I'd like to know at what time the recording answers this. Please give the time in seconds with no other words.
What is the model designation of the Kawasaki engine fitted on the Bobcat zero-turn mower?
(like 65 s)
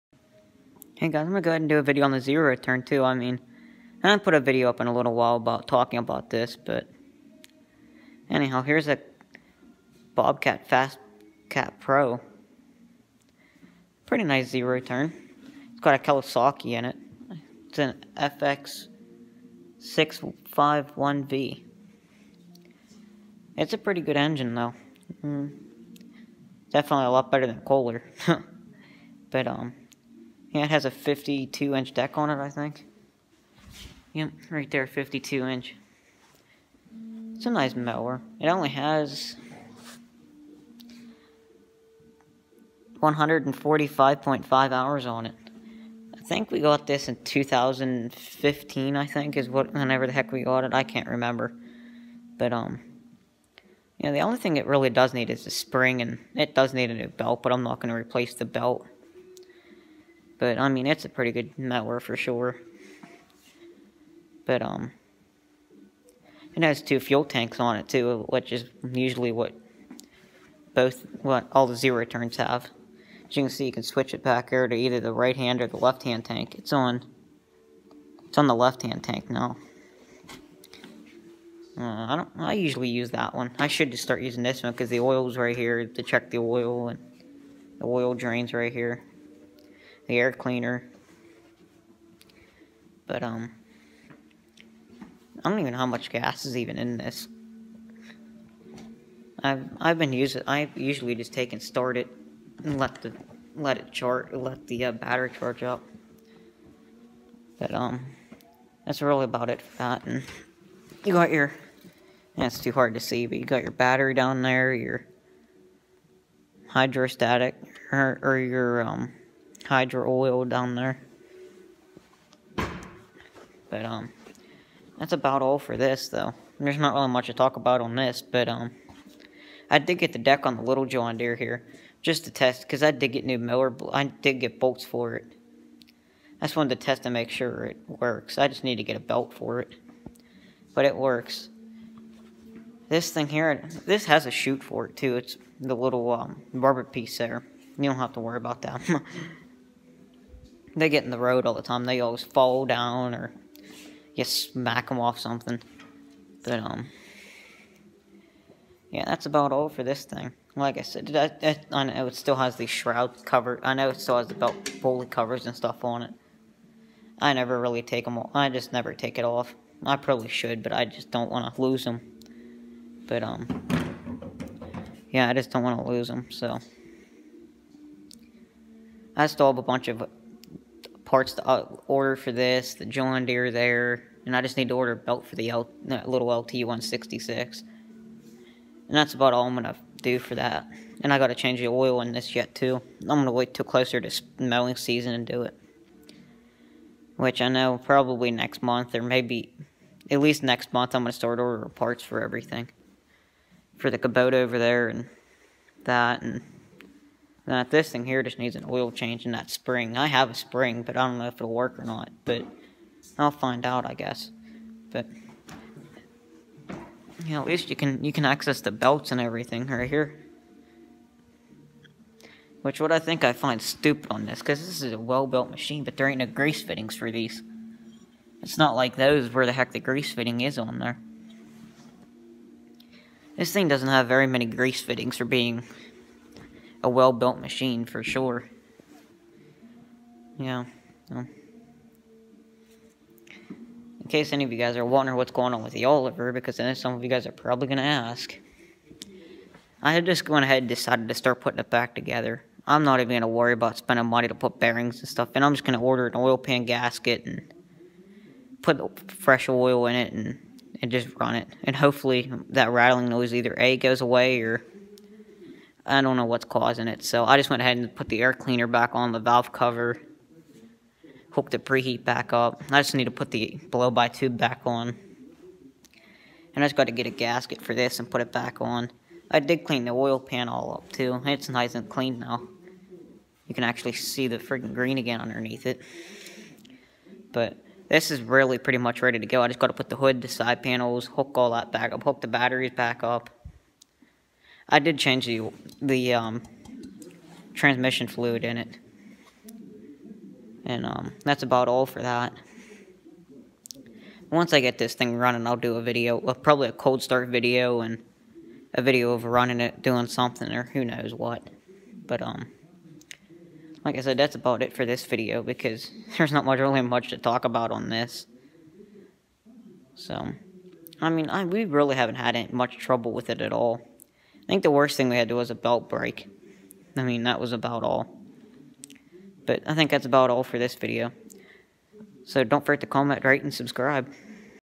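18 s.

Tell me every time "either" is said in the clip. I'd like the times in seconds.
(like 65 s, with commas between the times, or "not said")
74 s, 263 s.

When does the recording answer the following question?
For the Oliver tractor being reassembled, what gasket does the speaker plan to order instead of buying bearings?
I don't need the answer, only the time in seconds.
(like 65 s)
256 s.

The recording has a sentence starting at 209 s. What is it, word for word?
I have a spring, but I don't know if it'll work or not.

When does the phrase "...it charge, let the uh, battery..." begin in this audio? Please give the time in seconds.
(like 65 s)
103 s.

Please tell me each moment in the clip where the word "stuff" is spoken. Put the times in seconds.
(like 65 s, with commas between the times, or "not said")
165 s, 255 s.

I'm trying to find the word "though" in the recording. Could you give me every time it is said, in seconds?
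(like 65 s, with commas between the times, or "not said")
24 s, 126 s.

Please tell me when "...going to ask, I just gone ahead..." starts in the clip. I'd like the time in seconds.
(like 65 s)
247 s.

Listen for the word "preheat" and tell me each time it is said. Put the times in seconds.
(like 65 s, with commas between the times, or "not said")
271 s.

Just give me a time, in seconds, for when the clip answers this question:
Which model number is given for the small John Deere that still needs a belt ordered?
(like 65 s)
186 s.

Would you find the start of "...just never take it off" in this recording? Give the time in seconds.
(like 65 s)
168 s.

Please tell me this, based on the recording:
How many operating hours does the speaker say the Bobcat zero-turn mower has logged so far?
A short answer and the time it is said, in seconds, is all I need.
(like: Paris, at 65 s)
145.5, at 43 s.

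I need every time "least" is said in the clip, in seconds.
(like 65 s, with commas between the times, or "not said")
200 s, 217 s.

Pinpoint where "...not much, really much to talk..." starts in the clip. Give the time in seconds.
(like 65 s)
316 s.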